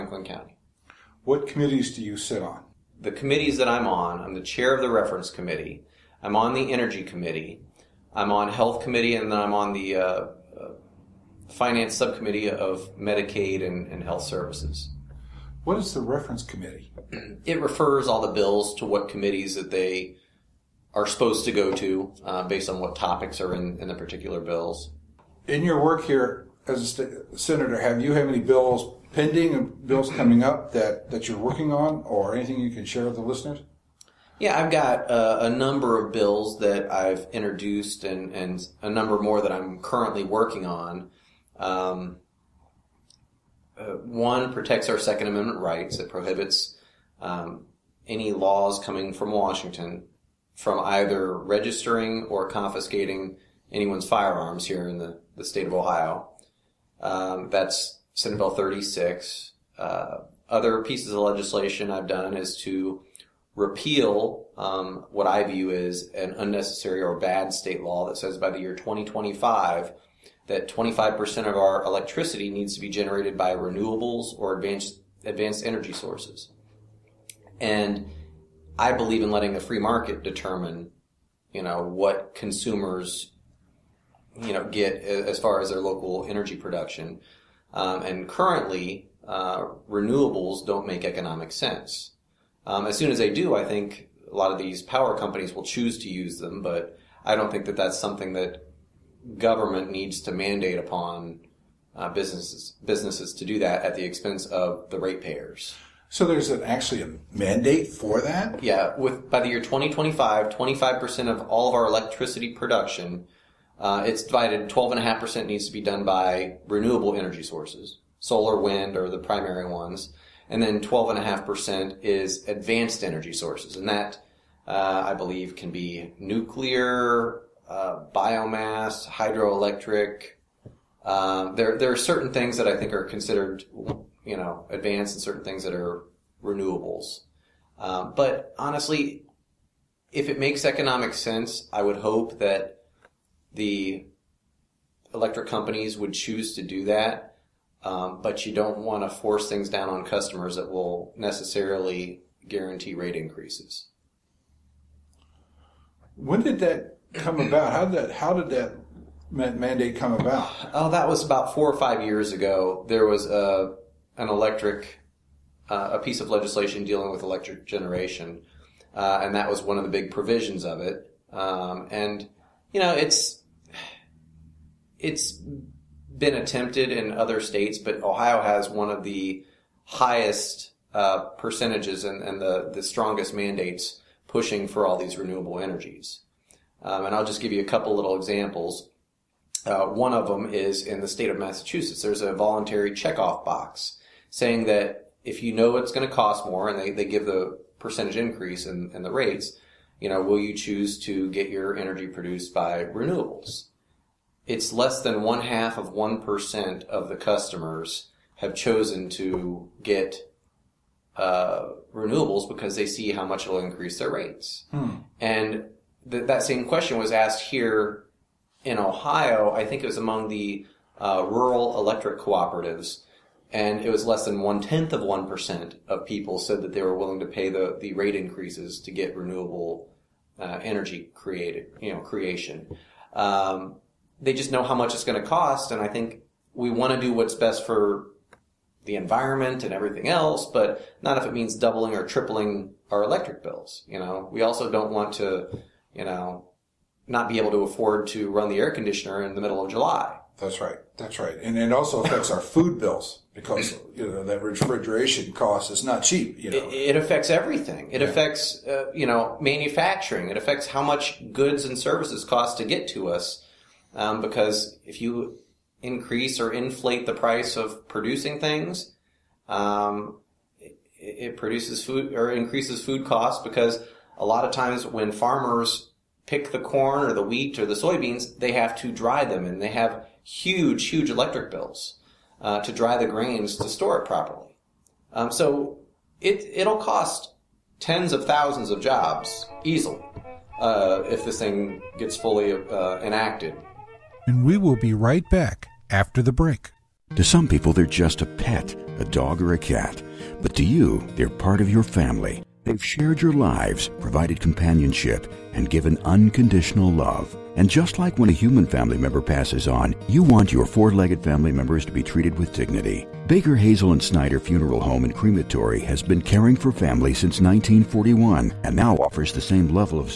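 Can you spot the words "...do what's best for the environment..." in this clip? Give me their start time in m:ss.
3:57.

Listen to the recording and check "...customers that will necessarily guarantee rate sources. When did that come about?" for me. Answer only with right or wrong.
wrong.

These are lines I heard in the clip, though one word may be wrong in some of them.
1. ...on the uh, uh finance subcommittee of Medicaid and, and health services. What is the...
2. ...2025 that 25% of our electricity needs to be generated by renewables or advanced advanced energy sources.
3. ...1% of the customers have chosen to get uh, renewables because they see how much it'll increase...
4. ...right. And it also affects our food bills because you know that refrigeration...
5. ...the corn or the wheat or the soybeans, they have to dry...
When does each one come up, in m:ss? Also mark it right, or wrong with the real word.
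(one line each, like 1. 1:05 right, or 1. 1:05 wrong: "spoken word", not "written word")
1. 0:09 right
2. 1:08 right
3. 3:25 right
4. 4:11 right
5. 4:36 right.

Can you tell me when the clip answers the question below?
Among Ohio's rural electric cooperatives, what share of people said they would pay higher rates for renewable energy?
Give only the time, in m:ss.
3:44.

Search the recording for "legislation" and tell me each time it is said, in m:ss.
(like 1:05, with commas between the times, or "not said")
1:01, 2:46.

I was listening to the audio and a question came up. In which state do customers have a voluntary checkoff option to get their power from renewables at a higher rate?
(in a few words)
Massachusetts.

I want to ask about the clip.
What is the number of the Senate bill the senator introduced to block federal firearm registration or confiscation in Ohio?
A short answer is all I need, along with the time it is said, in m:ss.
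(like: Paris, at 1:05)
Senate Bill 36, at 0:58.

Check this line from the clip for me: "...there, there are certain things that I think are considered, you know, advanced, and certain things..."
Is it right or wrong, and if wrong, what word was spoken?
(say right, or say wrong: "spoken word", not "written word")
right.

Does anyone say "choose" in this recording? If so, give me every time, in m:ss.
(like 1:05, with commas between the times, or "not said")
1:35, 2:26, 3:20.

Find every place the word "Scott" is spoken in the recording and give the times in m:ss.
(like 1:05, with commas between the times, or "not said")
not said.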